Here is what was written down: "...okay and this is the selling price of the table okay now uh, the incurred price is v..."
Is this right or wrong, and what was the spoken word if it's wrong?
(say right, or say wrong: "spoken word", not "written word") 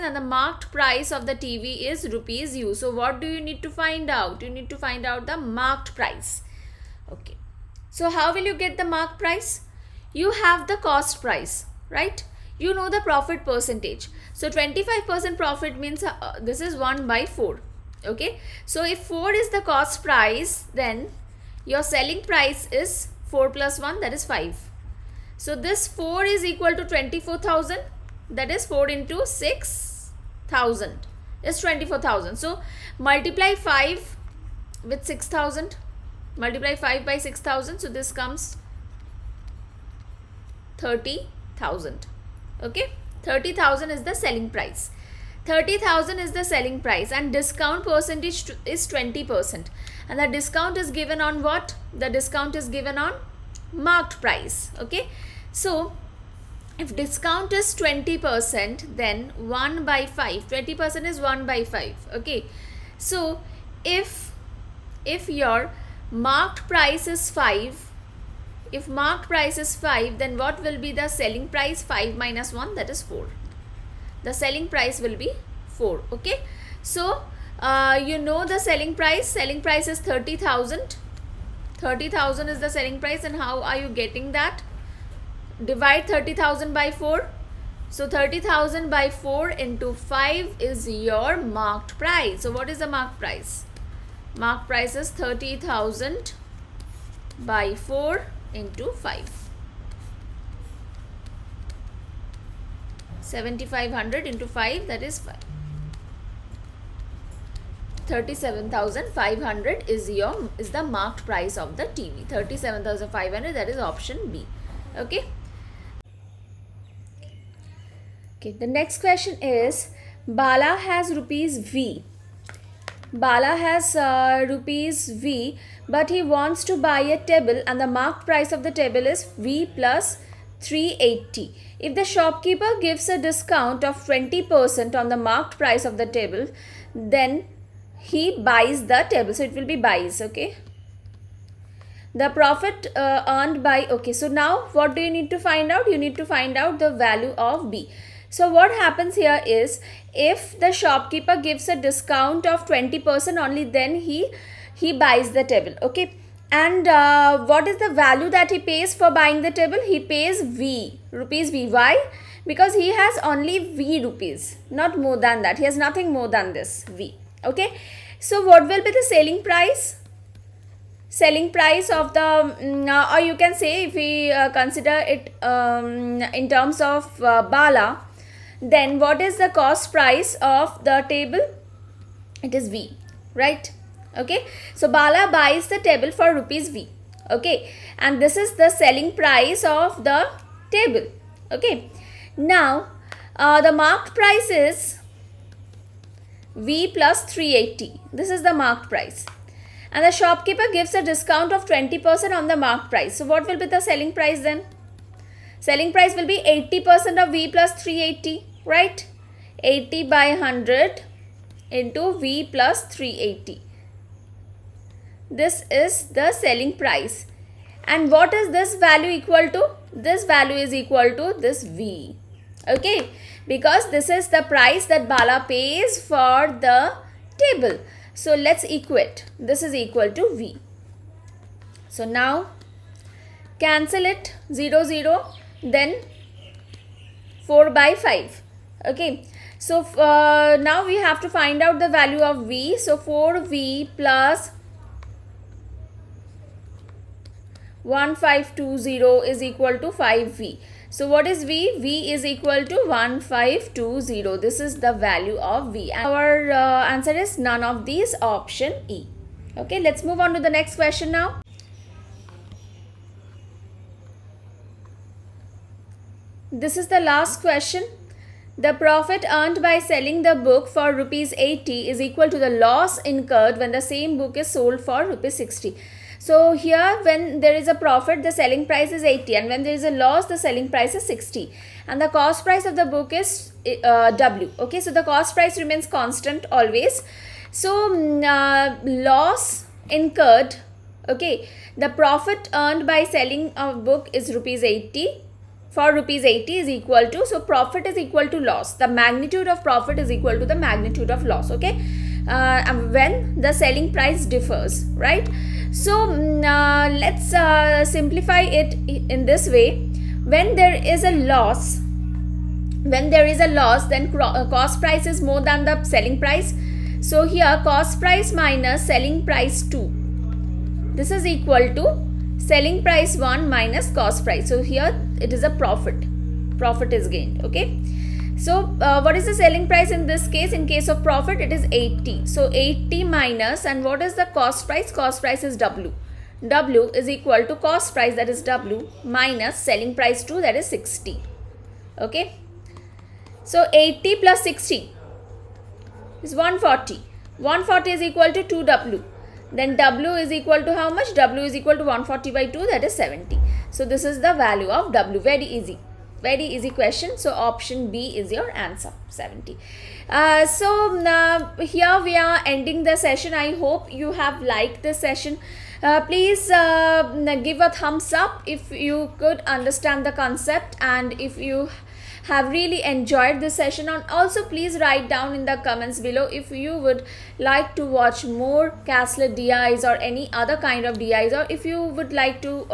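wrong: "marked", not "incurred".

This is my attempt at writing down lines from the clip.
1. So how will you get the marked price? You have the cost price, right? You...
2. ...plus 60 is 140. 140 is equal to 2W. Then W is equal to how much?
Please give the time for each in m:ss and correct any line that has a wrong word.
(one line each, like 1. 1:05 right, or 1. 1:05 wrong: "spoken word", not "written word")
1. 0:07 right
2. 5:44 right.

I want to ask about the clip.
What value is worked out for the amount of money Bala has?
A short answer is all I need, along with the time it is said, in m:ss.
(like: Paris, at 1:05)
1520, at 4:11.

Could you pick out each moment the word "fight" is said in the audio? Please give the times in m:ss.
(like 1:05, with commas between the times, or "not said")
not said.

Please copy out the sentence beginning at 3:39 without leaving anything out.
This value is equal to this V.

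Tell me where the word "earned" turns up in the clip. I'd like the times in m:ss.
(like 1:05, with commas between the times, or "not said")
2:23, 4:29, 4:52.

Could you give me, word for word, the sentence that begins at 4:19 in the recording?
Okay, let's move on to the next question now.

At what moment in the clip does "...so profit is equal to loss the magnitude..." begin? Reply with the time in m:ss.
4:57.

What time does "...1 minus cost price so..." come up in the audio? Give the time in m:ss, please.
5:23.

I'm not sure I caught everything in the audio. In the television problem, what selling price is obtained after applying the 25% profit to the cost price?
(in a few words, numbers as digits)
30,000.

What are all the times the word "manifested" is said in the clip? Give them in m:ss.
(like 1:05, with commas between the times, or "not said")
not said.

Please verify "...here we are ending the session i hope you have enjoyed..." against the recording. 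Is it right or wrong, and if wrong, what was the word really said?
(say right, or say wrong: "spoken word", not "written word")
wrong: "liked", not "enjoyed".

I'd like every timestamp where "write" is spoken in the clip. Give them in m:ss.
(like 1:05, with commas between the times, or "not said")
6:14.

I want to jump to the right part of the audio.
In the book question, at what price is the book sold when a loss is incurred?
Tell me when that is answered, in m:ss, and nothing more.
4:34.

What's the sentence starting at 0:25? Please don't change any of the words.
So this 4 is equal to 24,000 that is 4 into 6,000 is 24,000.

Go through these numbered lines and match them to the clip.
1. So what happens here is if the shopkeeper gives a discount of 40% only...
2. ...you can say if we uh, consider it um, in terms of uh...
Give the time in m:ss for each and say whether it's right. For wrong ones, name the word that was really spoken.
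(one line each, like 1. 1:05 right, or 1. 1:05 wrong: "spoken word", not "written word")
1. 2:28 wrong: "20", not "40"
2. 2:53 right.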